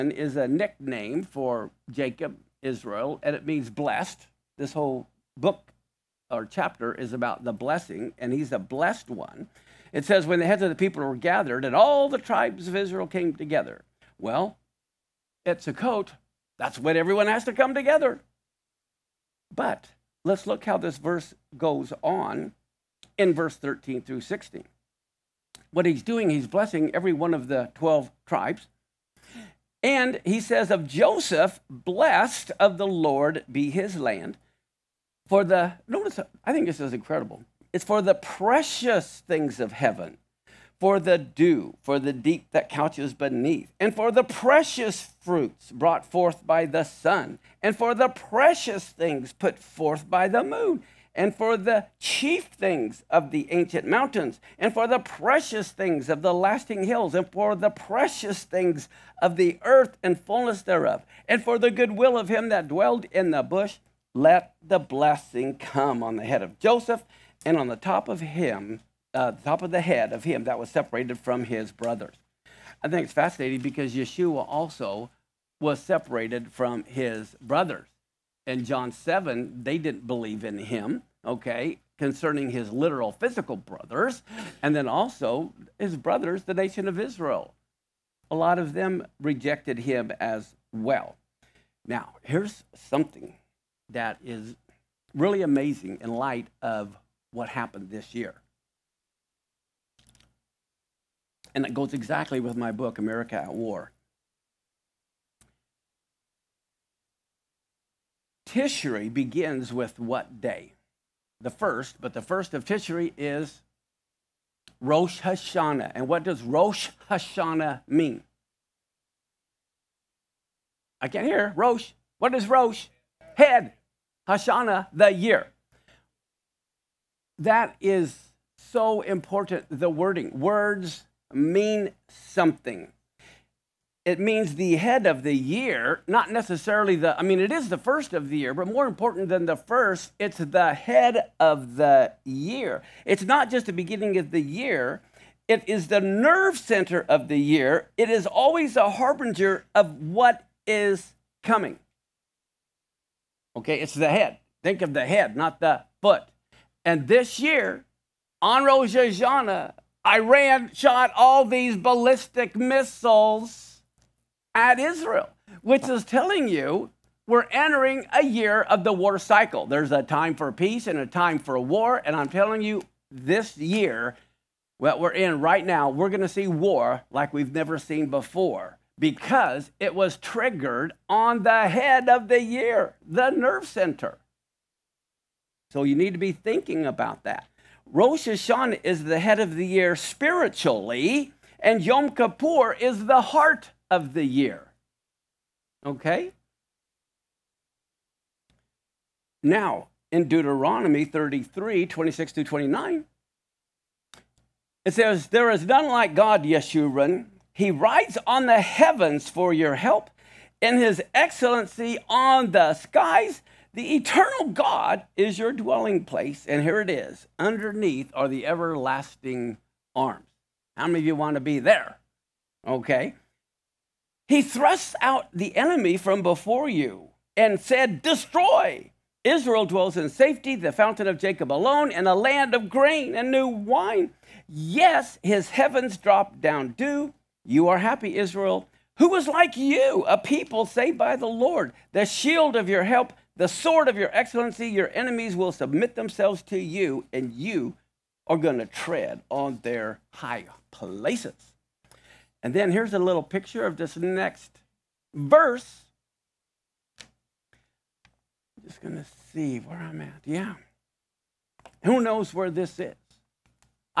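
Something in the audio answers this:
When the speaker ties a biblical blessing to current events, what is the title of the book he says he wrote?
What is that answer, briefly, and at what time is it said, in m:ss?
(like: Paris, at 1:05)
America at War, at 1:42.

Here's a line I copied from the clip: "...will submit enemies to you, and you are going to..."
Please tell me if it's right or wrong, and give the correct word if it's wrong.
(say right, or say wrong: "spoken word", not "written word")
wrong: "themselves", not "enemies".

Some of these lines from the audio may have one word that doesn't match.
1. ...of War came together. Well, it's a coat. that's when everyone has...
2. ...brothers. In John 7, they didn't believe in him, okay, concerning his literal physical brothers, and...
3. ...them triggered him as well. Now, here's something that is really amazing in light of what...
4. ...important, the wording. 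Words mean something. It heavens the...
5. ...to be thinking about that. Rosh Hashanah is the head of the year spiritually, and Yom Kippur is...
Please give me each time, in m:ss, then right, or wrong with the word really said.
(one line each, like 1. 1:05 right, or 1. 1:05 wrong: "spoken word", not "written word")
1. 0:12 wrong: "Israel", not "War"
2. 1:17 right
3. 1:28 wrong: "rejected", not "triggered"
4. 2:09 wrong: "means", not "heavens"
5. 3:06 right.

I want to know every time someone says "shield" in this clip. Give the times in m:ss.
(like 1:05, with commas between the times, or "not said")
4:02.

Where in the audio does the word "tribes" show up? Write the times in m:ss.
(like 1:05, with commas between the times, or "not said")
0:12, 0:28.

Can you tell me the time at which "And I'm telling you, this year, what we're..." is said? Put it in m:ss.
2:52.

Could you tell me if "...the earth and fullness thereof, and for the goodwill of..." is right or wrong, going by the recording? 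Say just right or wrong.
right.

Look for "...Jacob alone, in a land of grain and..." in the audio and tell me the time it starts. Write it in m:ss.
3:51.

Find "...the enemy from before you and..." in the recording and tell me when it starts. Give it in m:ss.
3:45.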